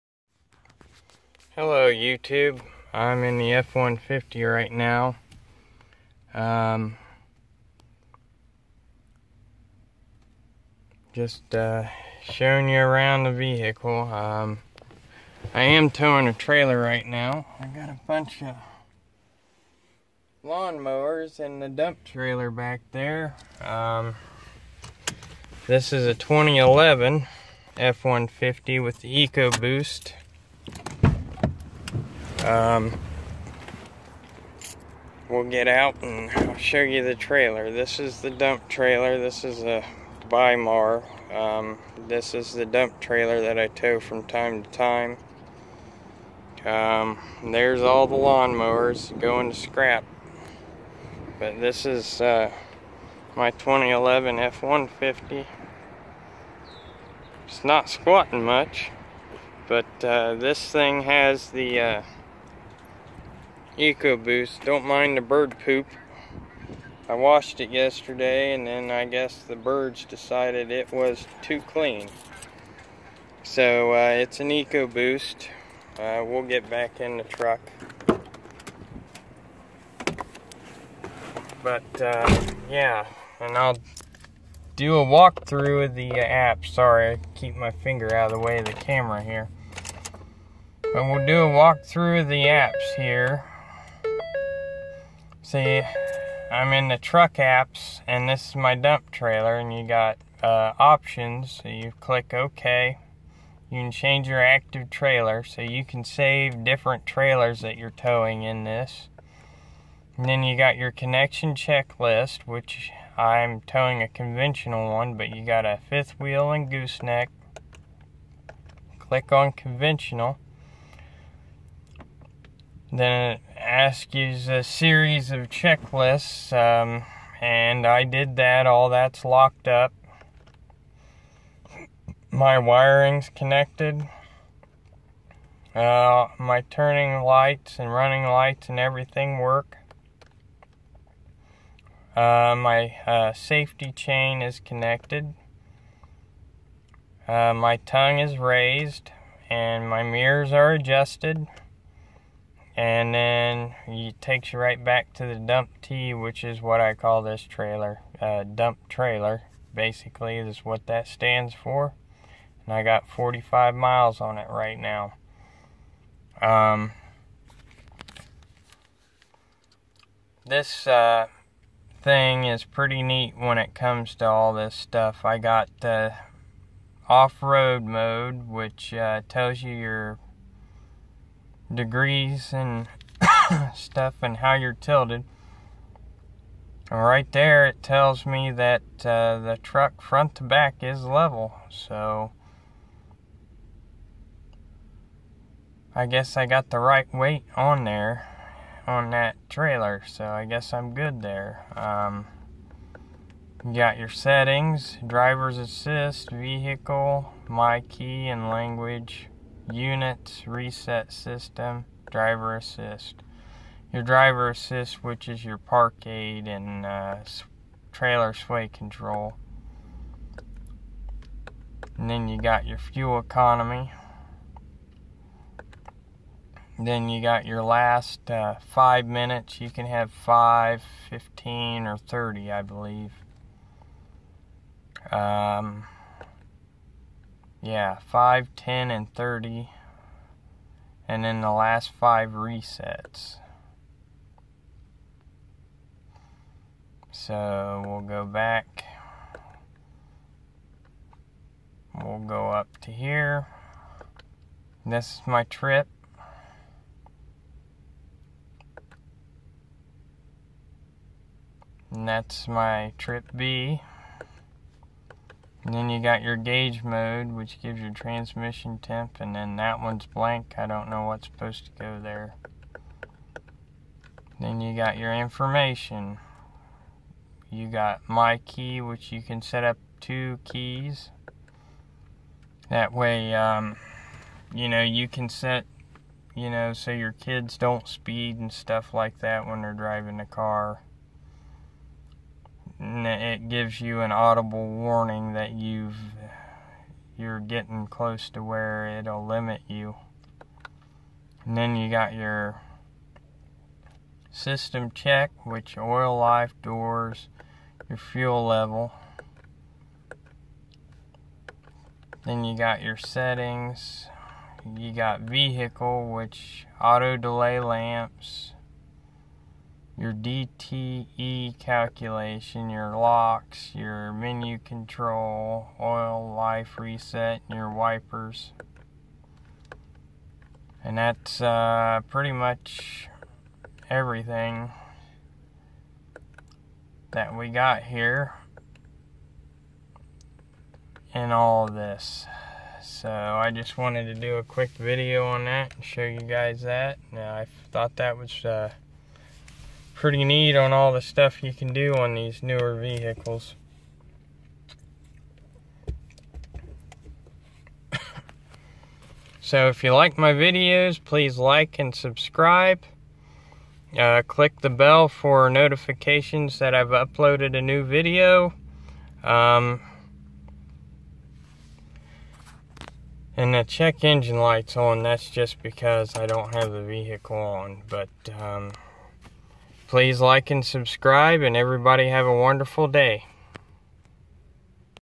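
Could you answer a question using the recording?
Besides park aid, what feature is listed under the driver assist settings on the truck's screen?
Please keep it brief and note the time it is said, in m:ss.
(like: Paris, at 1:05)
Trailer sway control, at 3:37.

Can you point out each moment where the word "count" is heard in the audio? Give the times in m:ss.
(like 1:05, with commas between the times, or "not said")
not said.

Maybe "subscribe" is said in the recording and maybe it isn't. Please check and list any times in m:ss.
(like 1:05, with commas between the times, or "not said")
6:01, 6:20.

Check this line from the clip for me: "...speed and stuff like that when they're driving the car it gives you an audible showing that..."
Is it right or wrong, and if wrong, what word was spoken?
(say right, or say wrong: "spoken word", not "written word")
wrong: "warning", not "showing".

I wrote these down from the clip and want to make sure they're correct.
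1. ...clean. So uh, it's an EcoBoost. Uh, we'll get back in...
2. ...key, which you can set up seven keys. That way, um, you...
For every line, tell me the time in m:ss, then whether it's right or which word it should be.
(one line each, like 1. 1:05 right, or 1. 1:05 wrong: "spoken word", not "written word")
1. 1:11 right
2. 4:38 wrong: "two", not "seven".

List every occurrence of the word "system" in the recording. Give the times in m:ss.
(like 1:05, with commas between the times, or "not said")
3:31, 5:04.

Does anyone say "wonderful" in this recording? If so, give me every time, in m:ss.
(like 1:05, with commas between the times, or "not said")
6:22.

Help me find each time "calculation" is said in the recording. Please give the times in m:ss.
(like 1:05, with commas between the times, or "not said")
5:21.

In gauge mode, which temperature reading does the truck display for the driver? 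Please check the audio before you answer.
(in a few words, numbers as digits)
Transmission temp.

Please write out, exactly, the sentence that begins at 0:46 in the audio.
Um, there's all the lawnmowers going to scrap.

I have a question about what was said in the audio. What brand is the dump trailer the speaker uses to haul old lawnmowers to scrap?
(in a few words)
Bri-Mar.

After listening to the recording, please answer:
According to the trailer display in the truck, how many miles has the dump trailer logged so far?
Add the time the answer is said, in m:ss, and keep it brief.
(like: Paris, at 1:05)
45, at 2:43.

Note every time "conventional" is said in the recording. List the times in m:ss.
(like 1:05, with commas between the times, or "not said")
1:54, 1:59.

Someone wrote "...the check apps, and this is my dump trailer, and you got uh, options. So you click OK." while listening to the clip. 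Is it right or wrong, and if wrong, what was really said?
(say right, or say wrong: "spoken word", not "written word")
wrong: "truck", not "check".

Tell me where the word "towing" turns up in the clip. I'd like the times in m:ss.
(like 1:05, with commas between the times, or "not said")
0:15, 1:47, 1:53.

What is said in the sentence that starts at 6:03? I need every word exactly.
Uh, click the bell for notifications that I've uploaded a new video.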